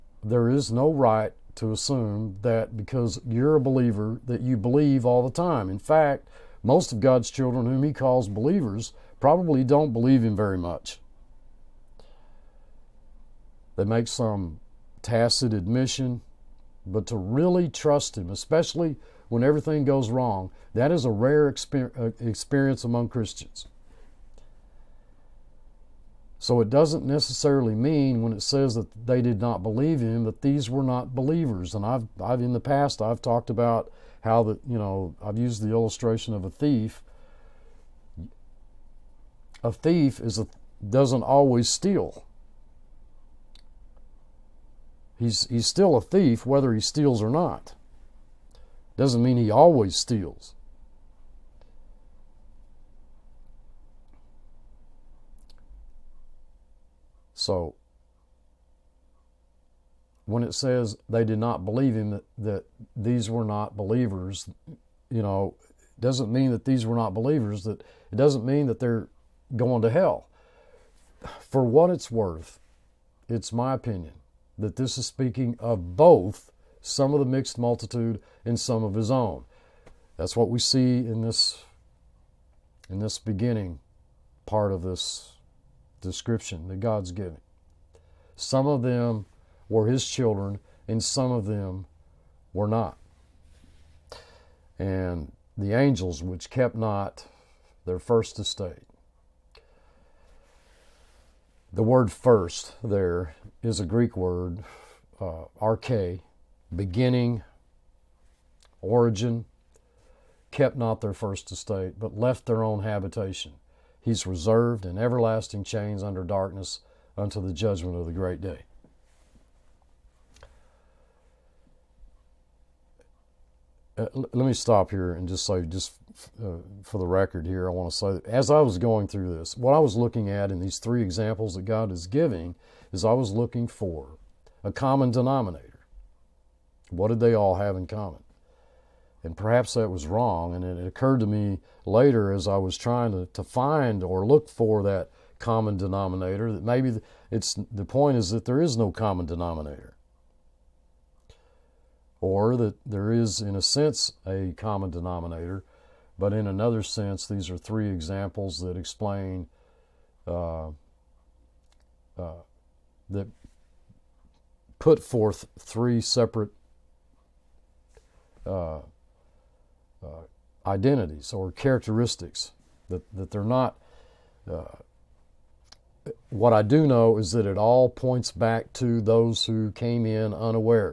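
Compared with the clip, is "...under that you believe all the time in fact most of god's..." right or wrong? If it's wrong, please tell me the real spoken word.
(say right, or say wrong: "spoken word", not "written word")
wrong: "believer", not "under".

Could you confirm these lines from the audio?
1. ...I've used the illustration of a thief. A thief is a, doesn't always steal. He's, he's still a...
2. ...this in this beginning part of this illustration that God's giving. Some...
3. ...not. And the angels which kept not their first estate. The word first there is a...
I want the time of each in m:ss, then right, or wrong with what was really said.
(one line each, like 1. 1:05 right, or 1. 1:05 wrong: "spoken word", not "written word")
1. 0:35 right
2. 1:21 wrong: "description", not "illustration"
3. 1:32 right.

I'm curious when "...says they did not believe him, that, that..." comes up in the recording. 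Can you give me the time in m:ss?
1:00.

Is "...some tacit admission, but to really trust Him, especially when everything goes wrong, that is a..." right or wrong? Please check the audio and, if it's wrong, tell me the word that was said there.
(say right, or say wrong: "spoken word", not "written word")
right.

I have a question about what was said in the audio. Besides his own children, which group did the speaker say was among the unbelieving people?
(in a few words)
The mixed multitude.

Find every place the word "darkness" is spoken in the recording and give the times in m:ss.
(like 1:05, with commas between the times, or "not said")
1:56.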